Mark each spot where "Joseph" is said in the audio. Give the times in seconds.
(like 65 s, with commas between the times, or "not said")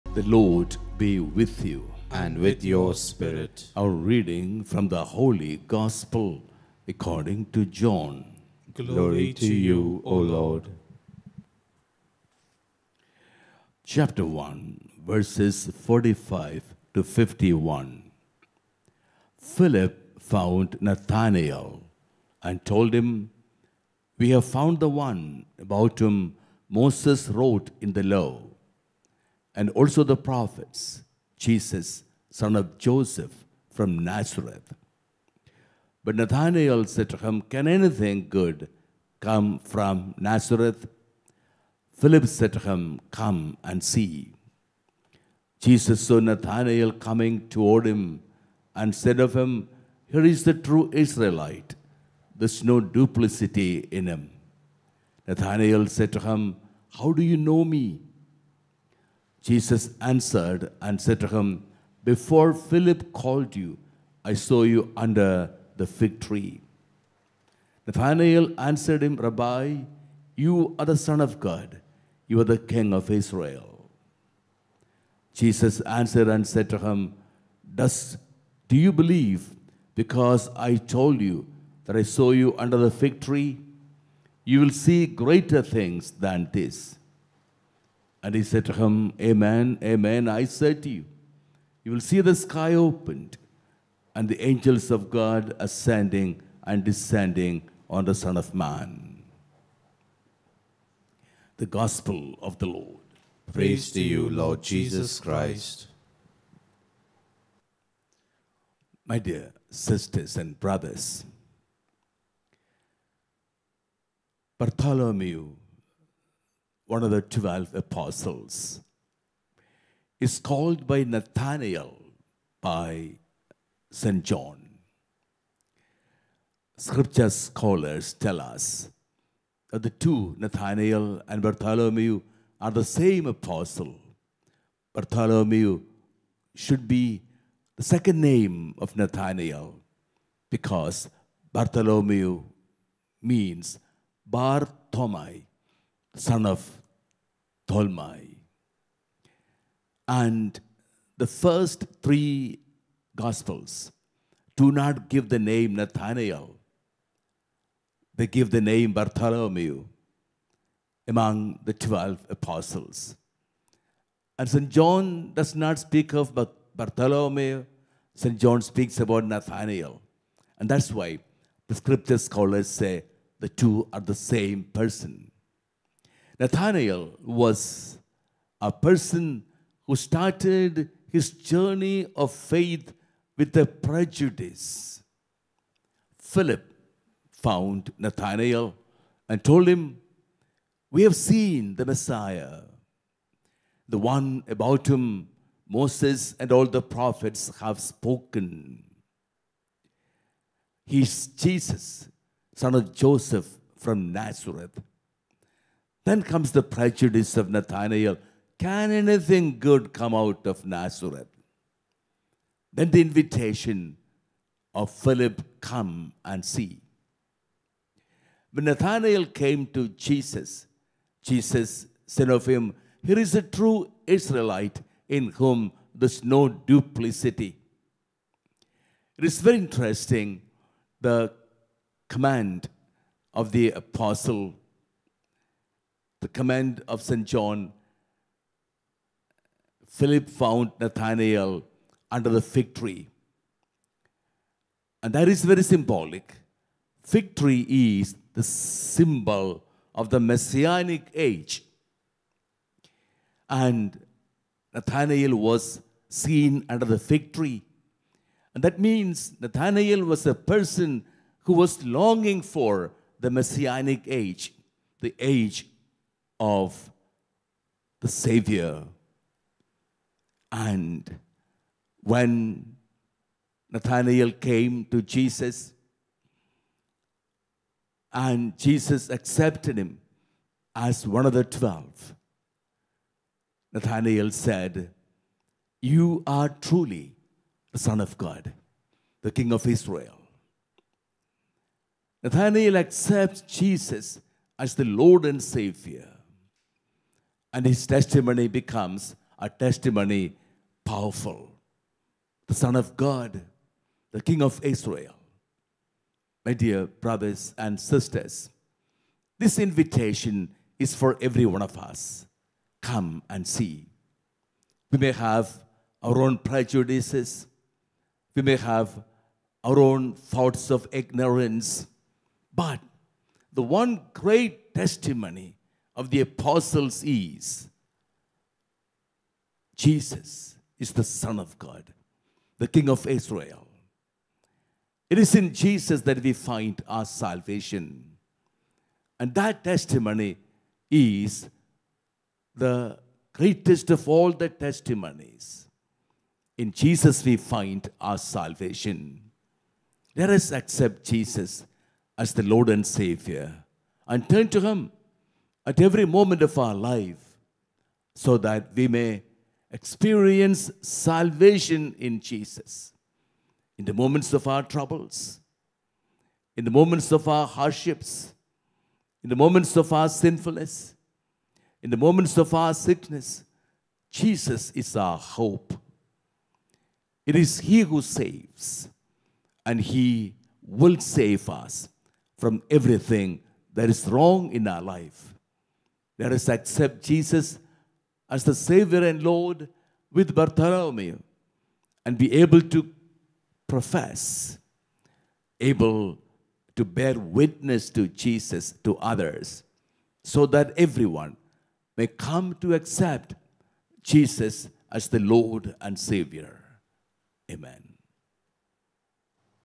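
32 s, 202 s.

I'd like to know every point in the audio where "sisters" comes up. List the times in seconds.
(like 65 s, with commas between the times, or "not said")
109 s, 307 s.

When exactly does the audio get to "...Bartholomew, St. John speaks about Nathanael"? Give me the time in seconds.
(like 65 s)
166 s.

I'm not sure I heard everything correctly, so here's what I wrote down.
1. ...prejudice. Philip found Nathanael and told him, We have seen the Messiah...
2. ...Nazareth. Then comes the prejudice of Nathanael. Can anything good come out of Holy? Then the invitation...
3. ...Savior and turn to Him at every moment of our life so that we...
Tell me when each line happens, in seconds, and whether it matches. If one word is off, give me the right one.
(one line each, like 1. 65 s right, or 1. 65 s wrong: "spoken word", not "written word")
1. 183 s right
2. 204 s wrong: "Nazareth", not "Holy"
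3. 353 s right.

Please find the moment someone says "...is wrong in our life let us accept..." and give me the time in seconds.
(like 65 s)
383 s.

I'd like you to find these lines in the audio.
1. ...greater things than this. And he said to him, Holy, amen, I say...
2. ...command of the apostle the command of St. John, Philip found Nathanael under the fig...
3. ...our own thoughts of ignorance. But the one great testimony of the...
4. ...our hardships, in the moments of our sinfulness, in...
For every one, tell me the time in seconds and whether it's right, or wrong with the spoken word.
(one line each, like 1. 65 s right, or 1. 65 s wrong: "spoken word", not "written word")
1. 85 s wrong: "Amen", not "Holy"
2. 232 s right
3. 319 s right
4. 367 s right.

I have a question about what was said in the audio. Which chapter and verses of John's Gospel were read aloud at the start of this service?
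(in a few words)
Chapter 1, verses 45 to 51.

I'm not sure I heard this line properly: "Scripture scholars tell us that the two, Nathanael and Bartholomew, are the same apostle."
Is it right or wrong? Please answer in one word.
right.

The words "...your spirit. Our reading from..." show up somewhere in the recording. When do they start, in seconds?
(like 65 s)
2 s.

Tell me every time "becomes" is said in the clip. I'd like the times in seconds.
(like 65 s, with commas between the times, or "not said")
298 s.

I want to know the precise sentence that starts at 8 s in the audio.
Glory, Glory to you, O Lord.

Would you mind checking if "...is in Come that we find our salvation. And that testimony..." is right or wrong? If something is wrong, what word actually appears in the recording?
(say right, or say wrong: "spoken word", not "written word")
wrong: "Jesus", not "Come".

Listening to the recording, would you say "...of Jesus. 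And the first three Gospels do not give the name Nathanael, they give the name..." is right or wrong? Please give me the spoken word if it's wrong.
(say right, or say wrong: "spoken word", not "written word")
wrong: "Tolmai", not "Jesus".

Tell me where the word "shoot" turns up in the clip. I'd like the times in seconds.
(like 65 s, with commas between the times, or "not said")
not said.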